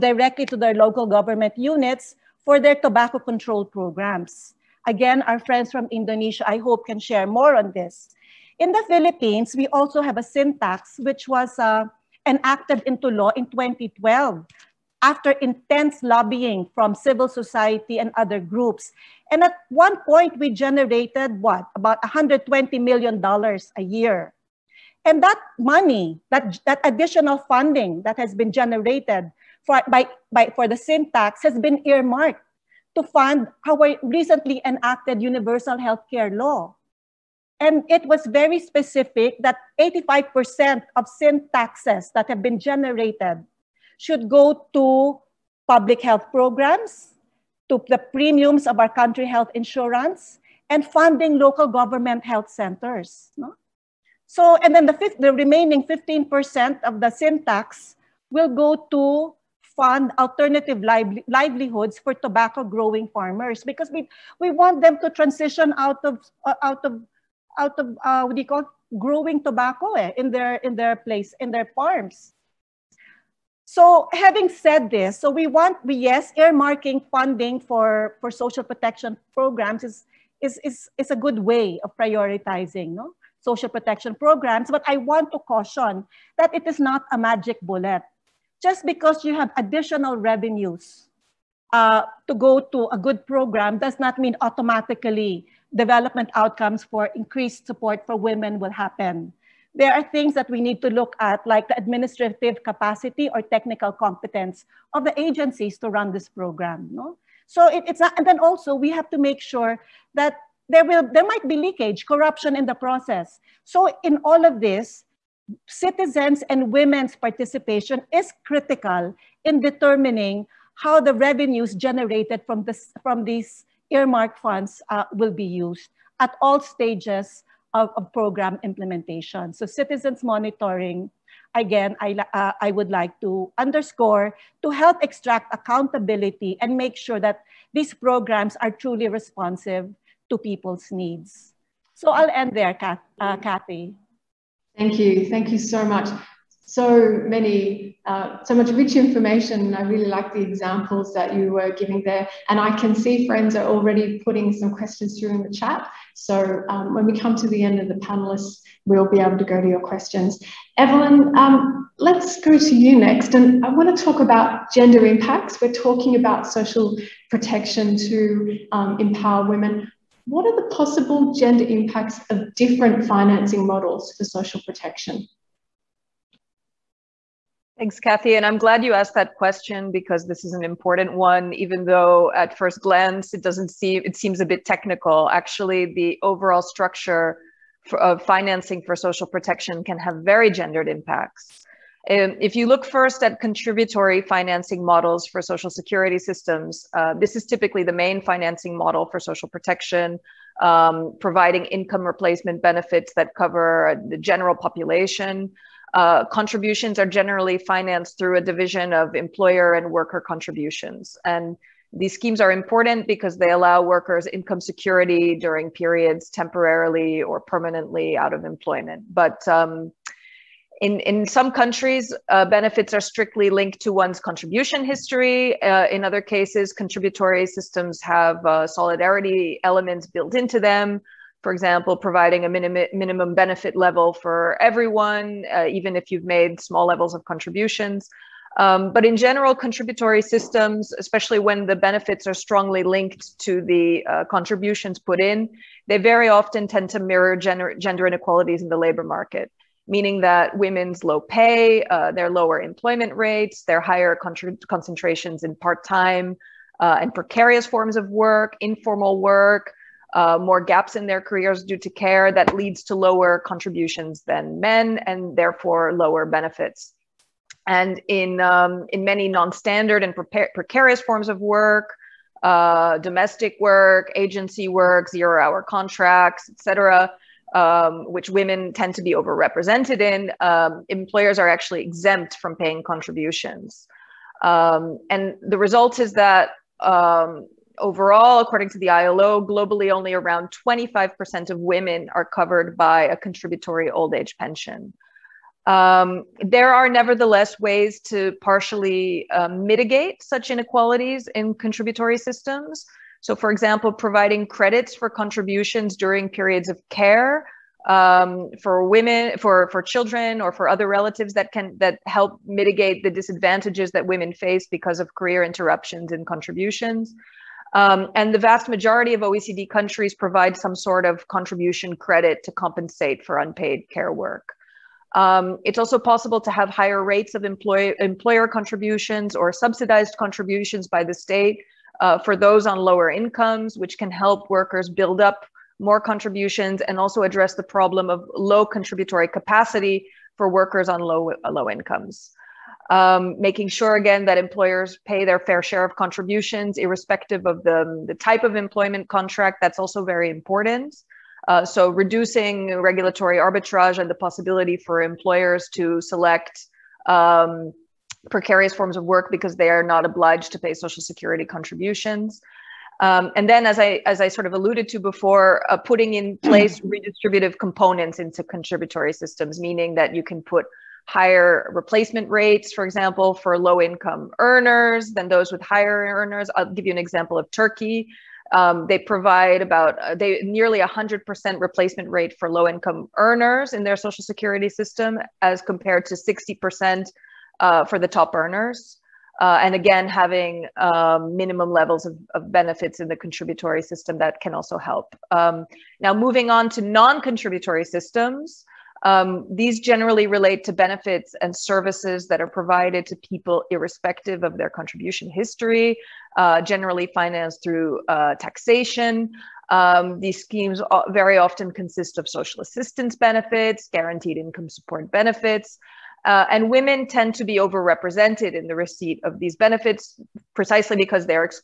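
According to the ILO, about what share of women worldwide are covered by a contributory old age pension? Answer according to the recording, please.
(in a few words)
25%.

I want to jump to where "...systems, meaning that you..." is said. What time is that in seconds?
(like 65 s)
369 s.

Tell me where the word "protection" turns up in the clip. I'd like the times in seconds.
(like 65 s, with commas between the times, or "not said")
78 s, 83 s, 167 s, 174 s, 189 s, 199 s.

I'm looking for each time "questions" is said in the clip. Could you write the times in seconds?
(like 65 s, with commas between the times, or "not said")
154 s, 159 s, 179 s.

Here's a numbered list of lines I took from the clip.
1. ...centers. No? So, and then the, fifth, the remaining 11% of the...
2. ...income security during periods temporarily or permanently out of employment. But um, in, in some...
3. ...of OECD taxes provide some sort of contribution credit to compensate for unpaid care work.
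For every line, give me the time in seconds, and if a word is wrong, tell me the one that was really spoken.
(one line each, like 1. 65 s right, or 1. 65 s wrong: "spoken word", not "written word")
1. 52 s wrong: "15", not "11"
2. 214 s right
3. 319 s wrong: "countries", not "taxes".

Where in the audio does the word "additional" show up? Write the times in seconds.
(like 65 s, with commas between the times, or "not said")
26 s, 89 s.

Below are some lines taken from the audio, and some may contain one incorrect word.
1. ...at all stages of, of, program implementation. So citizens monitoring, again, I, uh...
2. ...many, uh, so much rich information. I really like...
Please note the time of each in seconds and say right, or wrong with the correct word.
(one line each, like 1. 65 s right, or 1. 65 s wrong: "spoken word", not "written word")
1. 126 s right
2. 147 s right.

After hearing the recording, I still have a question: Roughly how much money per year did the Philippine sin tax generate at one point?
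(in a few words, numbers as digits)
$120 million.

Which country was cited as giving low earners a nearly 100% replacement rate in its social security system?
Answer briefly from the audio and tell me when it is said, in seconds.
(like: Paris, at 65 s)
Turkey, at 377 s.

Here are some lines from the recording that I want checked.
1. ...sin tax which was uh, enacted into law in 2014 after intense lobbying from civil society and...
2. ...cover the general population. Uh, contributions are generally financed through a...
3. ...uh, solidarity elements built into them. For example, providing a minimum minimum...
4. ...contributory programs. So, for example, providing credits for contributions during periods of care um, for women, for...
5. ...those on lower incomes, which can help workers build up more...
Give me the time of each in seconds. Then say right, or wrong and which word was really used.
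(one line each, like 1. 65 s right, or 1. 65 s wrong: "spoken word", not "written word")
1. 10 s wrong: "2012", not "2014"
2. 203 s right
3. 228 s right
4. 301 s wrong: "systems", not "programs"
5. 332 s right.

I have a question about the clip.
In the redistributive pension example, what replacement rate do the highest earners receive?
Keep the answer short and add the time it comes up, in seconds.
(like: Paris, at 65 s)
60%, at 386 s.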